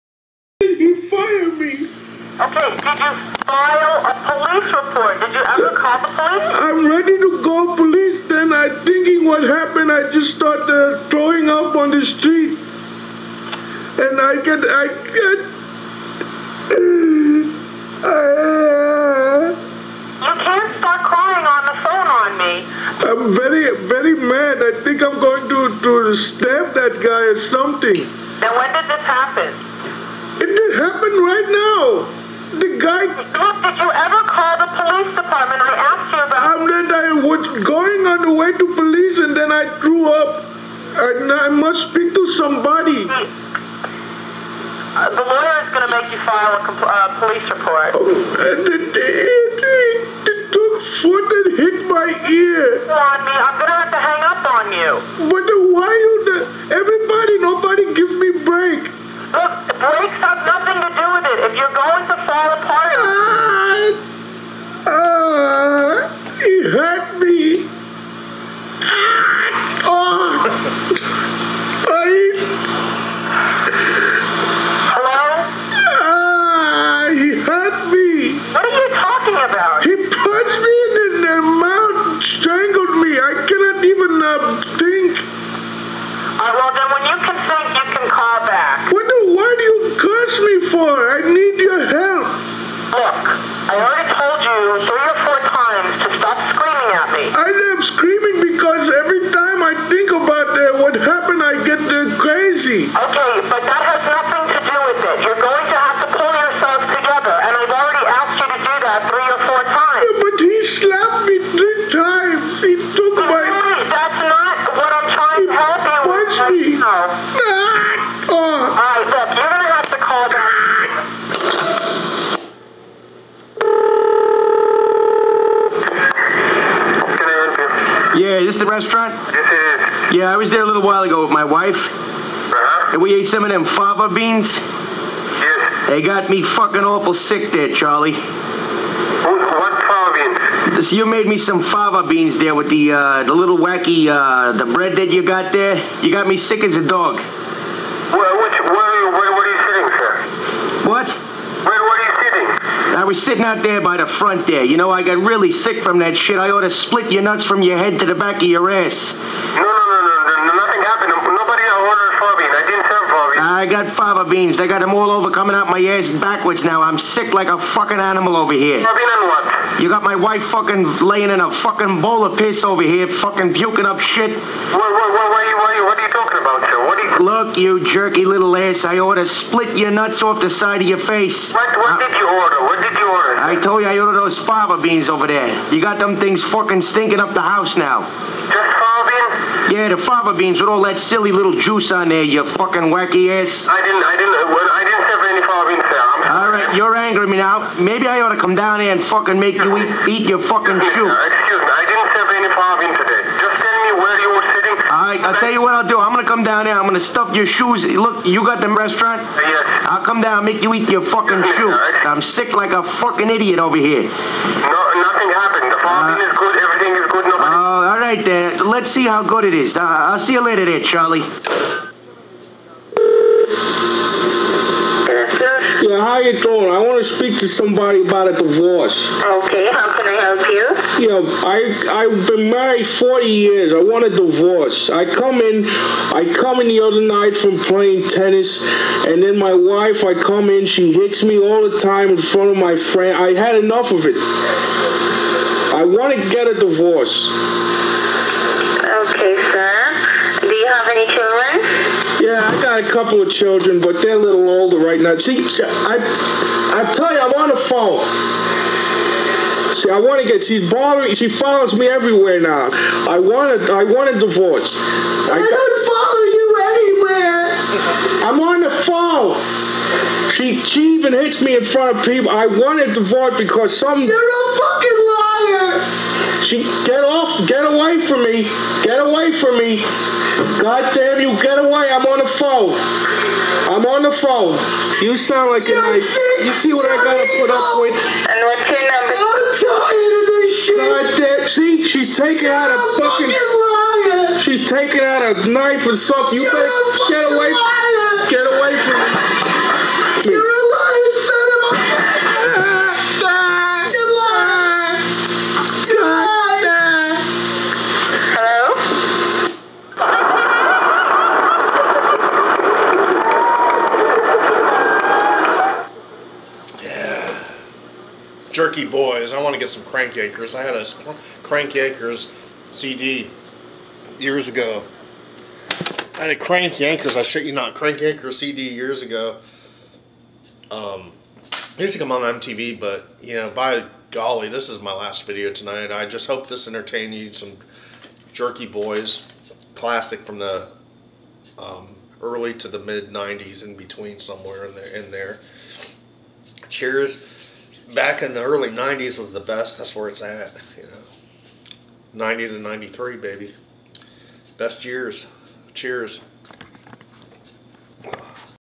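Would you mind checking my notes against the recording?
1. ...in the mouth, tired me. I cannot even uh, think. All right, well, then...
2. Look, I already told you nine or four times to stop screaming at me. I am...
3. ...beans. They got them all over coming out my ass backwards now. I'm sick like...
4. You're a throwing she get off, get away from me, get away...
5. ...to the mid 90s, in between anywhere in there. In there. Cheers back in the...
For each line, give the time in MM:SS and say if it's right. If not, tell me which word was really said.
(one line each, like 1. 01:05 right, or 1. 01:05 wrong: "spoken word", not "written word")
1. 01:21 wrong: "strangled", not "tired"
2. 01:32 wrong: "three", not "nine"
3. 02:44 right
4. 04:34 wrong: "fucking", not "throwing"
5. 05:42 wrong: "somewhere", not "anywhere".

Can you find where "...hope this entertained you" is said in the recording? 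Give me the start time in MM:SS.
05:36.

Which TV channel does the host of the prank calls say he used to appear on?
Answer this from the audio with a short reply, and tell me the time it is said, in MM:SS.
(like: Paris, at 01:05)
MTV, at 05:32.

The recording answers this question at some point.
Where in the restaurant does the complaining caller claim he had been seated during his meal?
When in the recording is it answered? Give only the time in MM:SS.
02:33.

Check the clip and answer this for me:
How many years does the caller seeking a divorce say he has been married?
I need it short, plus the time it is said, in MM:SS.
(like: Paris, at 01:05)
40, at 03:52.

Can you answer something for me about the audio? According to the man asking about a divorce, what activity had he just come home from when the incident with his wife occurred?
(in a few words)
tennis.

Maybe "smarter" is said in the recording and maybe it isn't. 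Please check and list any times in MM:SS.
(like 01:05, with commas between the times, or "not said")
not said.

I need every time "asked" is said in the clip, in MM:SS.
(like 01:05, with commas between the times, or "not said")
00:35.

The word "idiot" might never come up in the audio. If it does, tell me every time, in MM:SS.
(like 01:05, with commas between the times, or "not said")
03:33.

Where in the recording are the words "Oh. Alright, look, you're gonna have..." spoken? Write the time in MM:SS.
01:58.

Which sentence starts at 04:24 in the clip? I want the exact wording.
I, I don't follow you anywhere.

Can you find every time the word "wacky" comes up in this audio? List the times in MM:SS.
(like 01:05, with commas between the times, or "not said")
02:23, 03:12.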